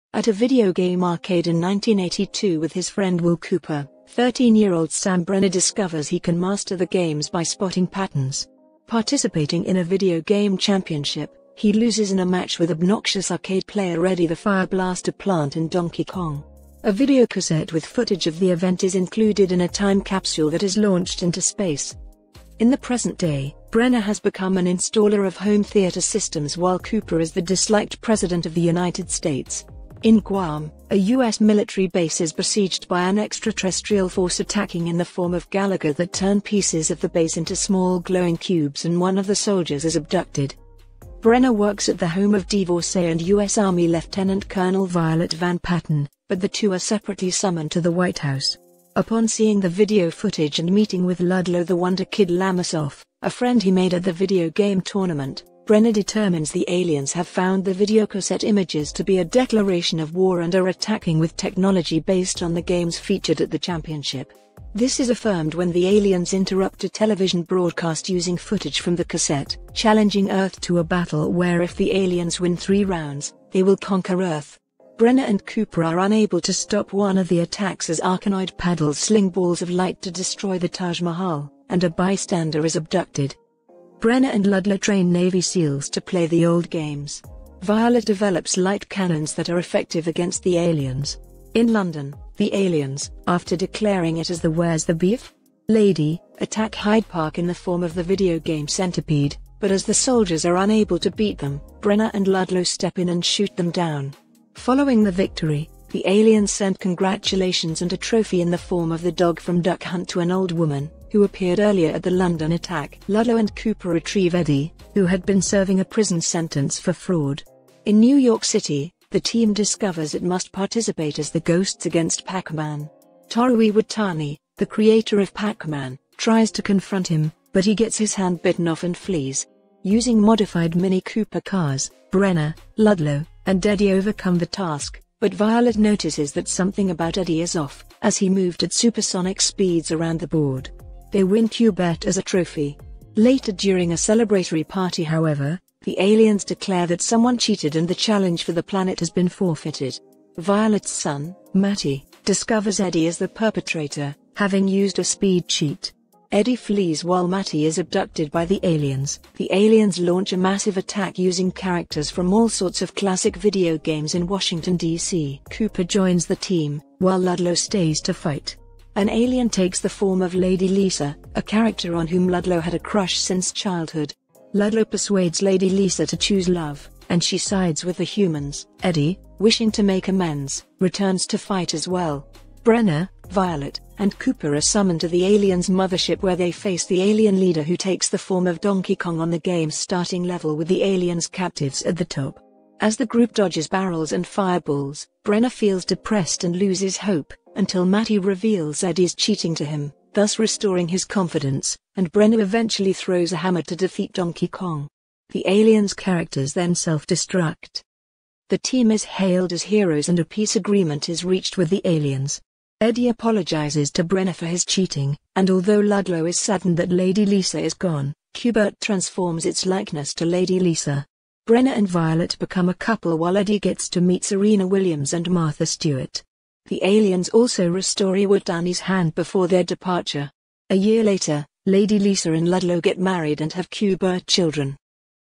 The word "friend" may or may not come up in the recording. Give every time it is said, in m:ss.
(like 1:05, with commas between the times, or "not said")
0:02, 0:53.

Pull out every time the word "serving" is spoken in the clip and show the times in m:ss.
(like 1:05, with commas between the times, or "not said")
1:55.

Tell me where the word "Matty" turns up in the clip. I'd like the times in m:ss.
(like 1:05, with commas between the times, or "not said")
2:31, 2:37, 3:17.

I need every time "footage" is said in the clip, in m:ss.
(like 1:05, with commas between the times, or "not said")
0:17, 0:50, 1:08.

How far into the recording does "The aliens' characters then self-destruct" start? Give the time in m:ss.
3:25.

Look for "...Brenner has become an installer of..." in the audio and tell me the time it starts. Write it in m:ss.
0:23.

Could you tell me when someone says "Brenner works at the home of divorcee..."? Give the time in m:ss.
0:41.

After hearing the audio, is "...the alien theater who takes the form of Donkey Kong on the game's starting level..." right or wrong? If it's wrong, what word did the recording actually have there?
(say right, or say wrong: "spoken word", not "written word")
wrong: "leader", not "theater".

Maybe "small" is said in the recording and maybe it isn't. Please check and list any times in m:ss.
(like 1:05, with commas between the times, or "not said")
0:37.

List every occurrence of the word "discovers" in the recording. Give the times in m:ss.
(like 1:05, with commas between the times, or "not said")
0:05, 1:59, 2:32.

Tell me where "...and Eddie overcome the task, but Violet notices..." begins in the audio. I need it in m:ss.
2:13.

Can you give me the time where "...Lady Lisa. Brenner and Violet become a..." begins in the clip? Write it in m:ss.
3:40.